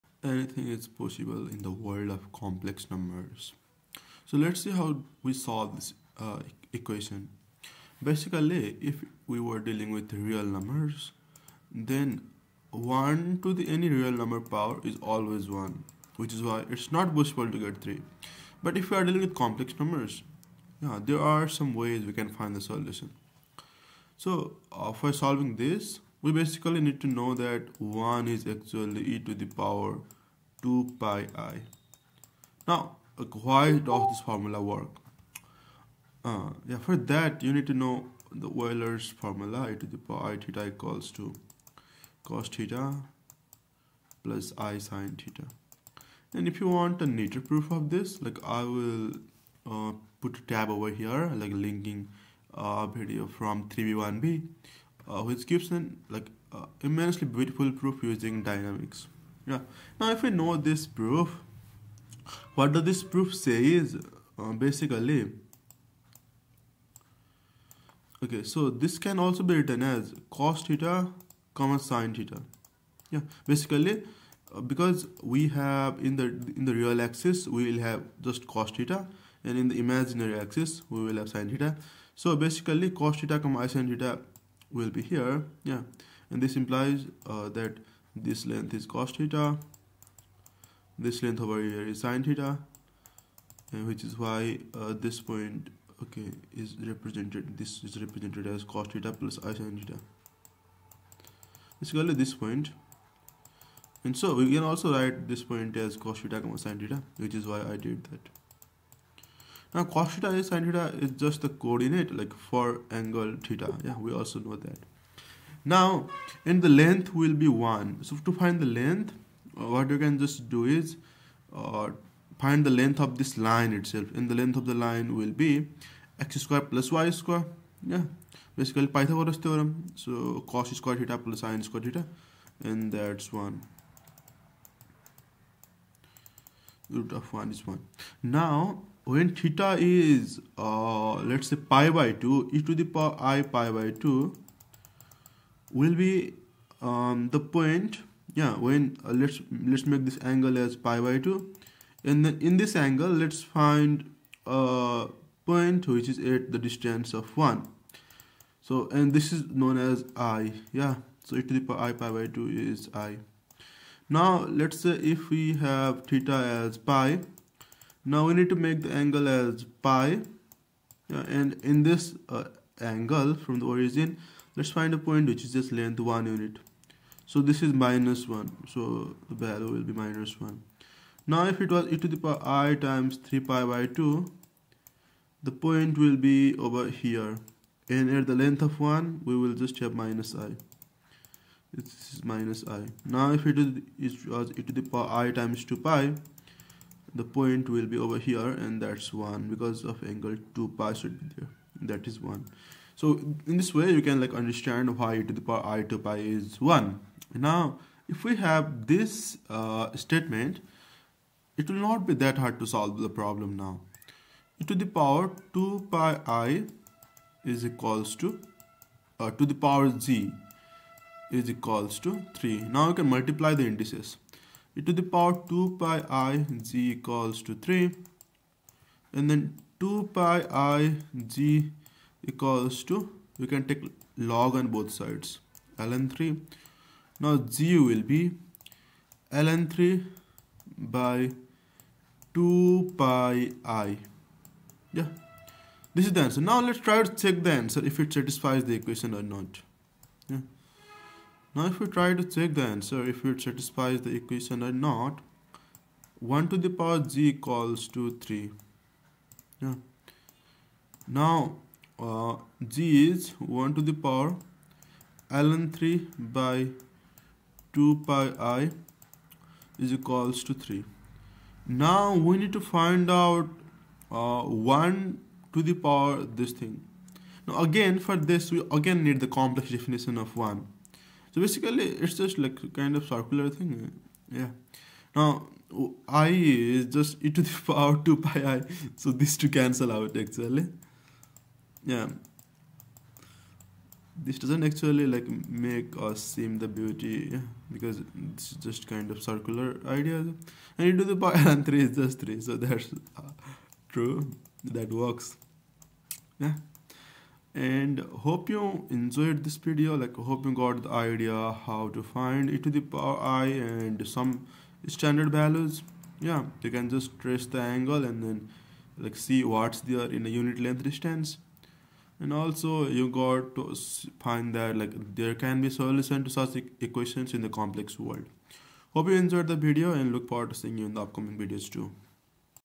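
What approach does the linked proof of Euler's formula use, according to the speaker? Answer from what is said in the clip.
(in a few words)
dynamics.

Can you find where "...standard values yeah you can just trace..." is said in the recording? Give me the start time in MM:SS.
05:14.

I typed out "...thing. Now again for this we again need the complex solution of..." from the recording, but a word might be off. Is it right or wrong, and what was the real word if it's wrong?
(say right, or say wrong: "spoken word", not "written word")
wrong: "definition", not "solution".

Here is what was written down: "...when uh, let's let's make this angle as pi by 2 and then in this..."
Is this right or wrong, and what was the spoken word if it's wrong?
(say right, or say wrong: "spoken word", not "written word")
right.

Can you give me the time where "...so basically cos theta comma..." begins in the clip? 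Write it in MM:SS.
01:22.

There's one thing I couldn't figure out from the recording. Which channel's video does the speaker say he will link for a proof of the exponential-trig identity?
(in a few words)
3b1b.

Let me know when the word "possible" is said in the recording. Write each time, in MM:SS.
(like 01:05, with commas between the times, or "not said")
00:00, 00:17.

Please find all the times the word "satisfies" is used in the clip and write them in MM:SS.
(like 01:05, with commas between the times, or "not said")
04:08, 04:13.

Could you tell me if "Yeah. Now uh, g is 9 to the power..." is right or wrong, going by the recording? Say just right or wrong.
wrong.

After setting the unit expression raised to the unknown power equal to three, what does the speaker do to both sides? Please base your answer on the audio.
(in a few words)
take log.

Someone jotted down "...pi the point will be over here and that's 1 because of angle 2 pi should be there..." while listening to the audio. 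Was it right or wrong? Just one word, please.
right.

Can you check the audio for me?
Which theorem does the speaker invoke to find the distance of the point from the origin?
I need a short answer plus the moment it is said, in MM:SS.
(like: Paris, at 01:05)
Pythagoras theorem, at 02:08.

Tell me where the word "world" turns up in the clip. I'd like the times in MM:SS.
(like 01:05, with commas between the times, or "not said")
00:01, 05:27.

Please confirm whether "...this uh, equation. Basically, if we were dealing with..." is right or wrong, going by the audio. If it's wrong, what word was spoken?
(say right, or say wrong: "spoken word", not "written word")
right.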